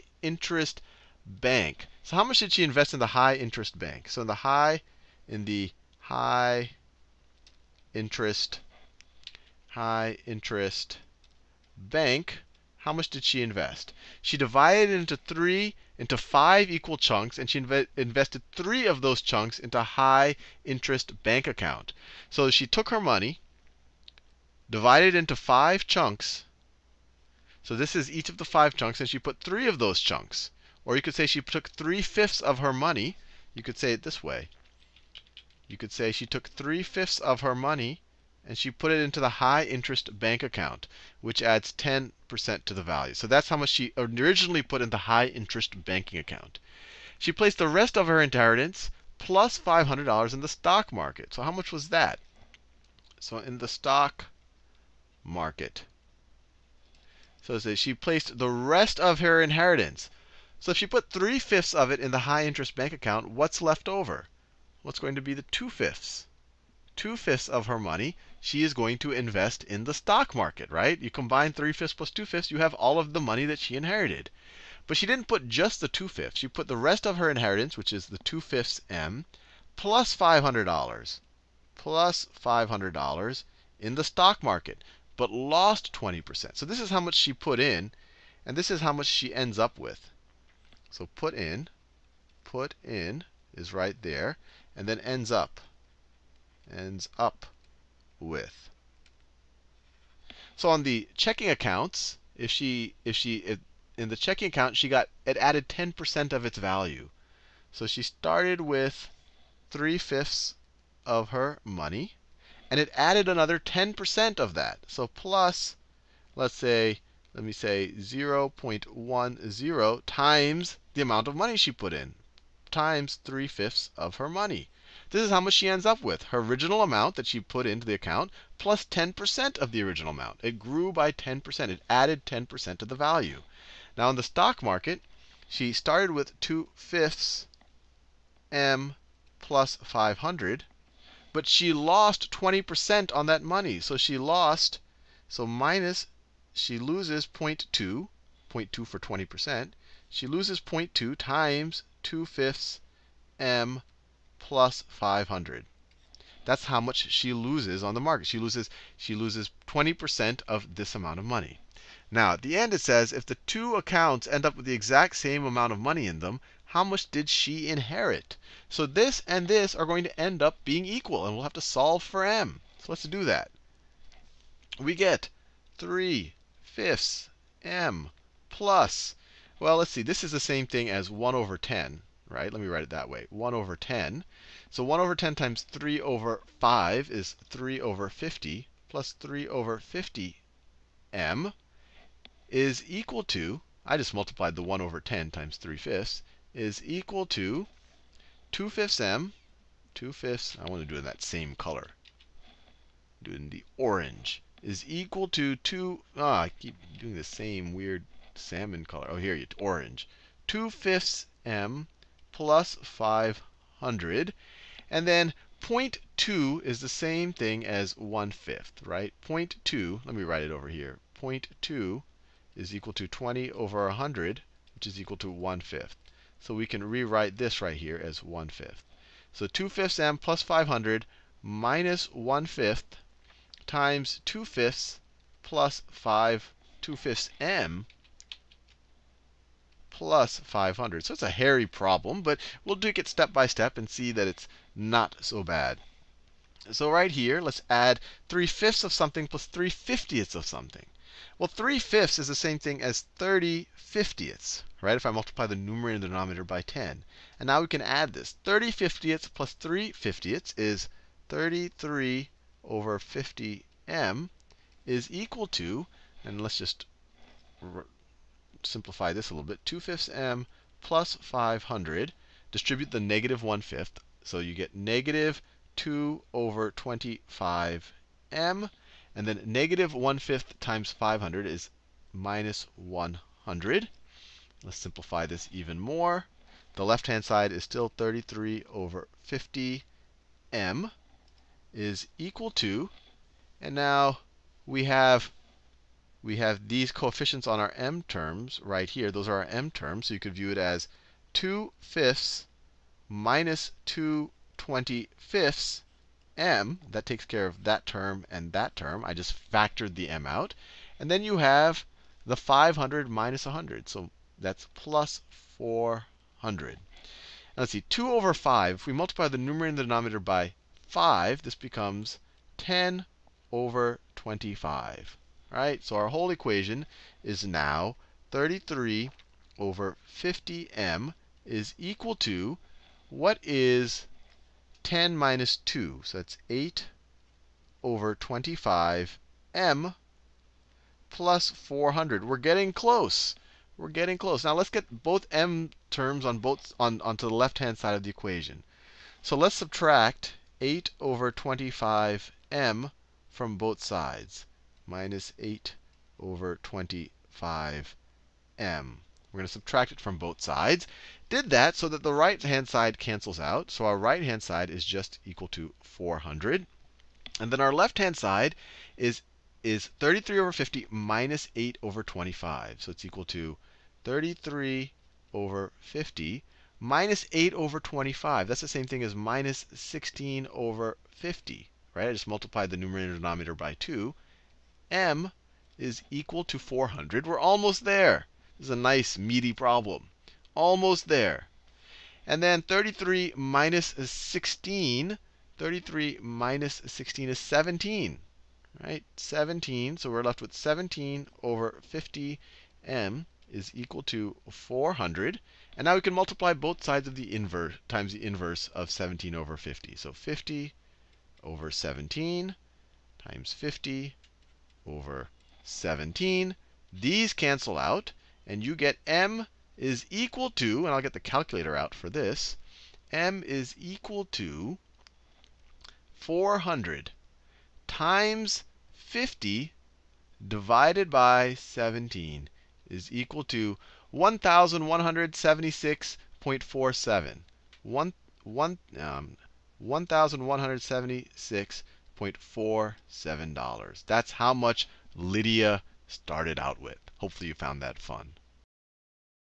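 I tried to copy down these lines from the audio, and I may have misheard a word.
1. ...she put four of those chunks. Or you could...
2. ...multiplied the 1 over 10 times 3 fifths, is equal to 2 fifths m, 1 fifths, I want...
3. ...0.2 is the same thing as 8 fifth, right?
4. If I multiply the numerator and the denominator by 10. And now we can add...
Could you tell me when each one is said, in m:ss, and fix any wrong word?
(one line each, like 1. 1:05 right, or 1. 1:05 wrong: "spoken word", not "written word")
1. 0:29 wrong: "three", not "four"
2. 3:14 wrong: "2", not "1"
3. 3:35 wrong: "1", not "8"
4. 4:14 right.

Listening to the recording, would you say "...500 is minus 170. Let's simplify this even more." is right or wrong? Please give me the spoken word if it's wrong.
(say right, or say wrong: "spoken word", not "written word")
wrong: "100", not "170".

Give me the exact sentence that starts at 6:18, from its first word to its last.
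That's the same thing as minus 16 over 50, right?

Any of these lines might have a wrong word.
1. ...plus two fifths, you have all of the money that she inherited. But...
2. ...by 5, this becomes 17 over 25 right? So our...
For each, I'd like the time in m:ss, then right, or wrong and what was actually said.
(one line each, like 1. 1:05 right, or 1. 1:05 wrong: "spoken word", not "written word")
1. 1:11 right
2. 5:20 wrong: "10", not "17".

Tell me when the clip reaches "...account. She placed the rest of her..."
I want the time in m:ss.
0:46.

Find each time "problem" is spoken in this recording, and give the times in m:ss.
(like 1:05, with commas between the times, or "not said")
4:01, 6:29.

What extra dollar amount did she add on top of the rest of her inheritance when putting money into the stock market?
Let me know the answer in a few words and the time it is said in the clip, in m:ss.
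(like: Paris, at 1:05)
$500, at 1:19.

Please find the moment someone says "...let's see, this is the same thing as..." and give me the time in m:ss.
2:59.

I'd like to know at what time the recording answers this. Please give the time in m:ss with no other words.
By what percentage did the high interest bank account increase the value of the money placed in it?
0:41.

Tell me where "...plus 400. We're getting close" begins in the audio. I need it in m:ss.
5:41.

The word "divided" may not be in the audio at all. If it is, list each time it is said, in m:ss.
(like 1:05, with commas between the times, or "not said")
0:14, 0:24.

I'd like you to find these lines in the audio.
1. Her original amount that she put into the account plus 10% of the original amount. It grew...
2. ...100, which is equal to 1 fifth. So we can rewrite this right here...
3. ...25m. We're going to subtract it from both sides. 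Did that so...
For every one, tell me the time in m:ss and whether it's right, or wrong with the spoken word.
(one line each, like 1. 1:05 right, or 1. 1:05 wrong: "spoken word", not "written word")
1. 2:06 right
2. 3:43 right
3. 5:56 right.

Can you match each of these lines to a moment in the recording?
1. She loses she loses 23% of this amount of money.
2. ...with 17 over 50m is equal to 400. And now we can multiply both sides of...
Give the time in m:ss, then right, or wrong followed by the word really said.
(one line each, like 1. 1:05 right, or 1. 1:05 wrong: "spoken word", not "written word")
1. 2:38 wrong: "20", not "23"
2. 6:40 right.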